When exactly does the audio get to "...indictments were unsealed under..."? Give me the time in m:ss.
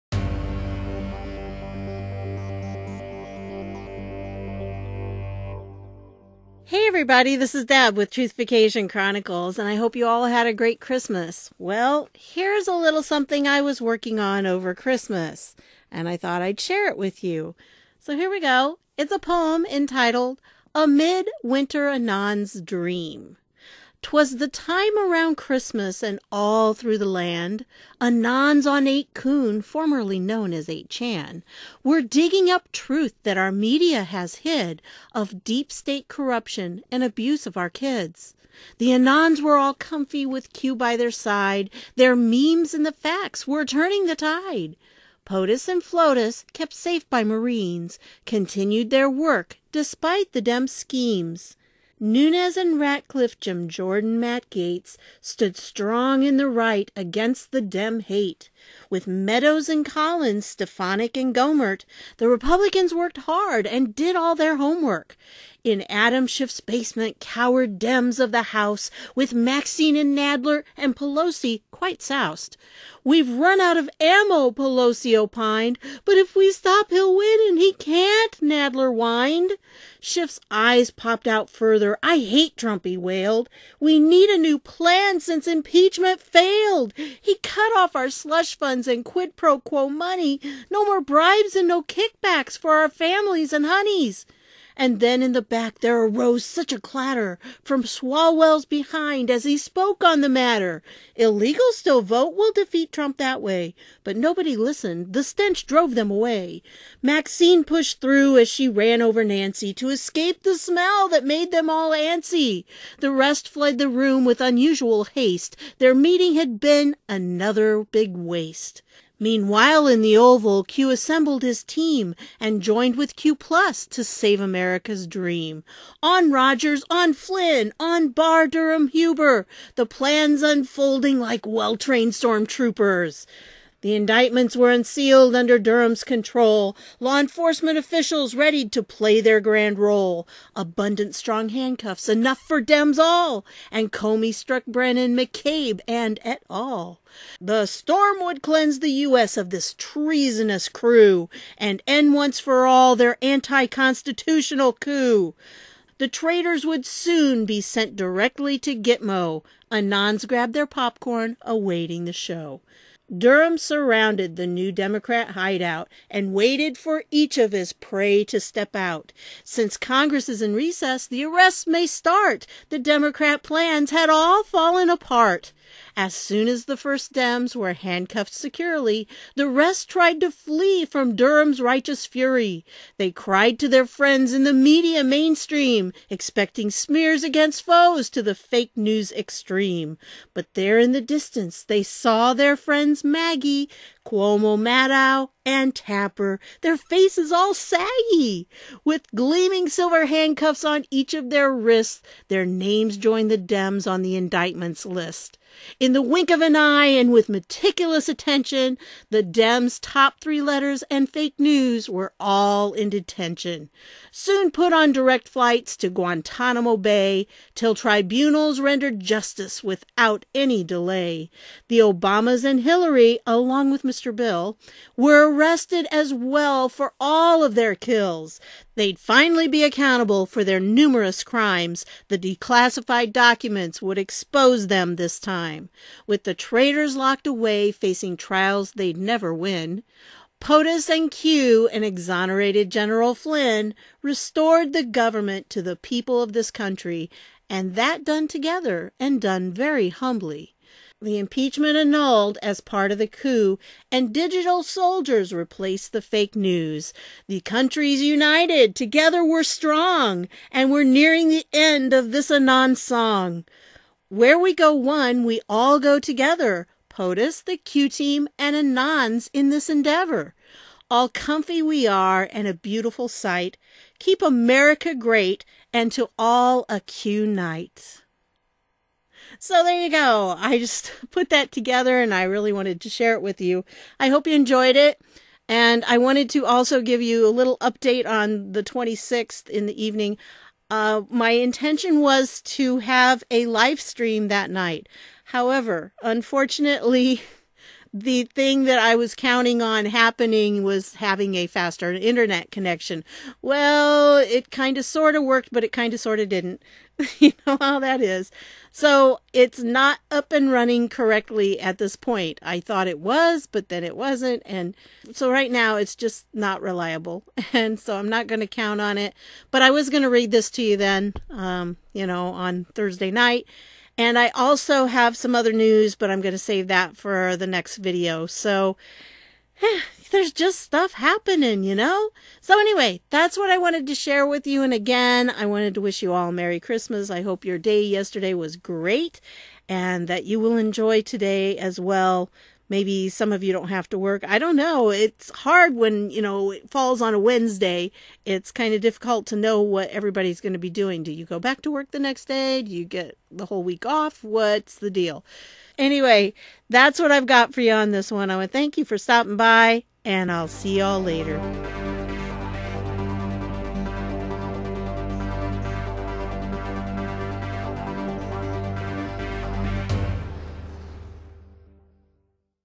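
2:13.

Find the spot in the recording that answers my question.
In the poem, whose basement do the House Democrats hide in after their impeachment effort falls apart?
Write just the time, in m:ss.
1:05.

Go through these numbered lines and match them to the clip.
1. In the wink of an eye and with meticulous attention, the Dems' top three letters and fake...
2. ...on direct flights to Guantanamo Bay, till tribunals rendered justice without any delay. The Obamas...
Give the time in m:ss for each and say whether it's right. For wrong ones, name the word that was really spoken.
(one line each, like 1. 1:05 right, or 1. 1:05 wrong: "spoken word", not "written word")
1. 3:25 right
2. 3:34 right.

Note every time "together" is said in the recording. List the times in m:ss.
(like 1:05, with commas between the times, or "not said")
4:08, 4:18, 4:25, 4:41.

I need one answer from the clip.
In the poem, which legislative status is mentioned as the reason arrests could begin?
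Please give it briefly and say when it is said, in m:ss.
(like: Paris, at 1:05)
recess, at 2:50.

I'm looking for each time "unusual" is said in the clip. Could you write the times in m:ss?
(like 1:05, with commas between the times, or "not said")
1:54.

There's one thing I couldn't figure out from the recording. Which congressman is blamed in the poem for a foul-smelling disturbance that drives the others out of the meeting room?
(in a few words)
Swalwell.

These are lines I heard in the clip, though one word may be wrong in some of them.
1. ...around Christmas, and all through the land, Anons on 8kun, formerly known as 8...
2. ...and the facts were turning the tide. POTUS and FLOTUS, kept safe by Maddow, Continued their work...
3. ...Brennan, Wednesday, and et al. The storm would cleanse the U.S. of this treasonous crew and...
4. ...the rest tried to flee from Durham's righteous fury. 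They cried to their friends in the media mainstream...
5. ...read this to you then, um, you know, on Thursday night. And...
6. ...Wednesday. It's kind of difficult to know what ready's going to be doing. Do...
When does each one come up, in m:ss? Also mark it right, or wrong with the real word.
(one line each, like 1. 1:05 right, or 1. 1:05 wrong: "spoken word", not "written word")
1. 0:24 right
2. 0:42 wrong: "Marines", not "Maddow"
3. 2:24 wrong: "McCabe", not "Wednesday"
4. 2:59 right
5. 5:20 right
6. 5:47 wrong: "everybody", not "ready".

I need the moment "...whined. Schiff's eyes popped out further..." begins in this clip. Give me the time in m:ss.
1:18.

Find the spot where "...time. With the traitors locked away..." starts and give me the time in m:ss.
3:55.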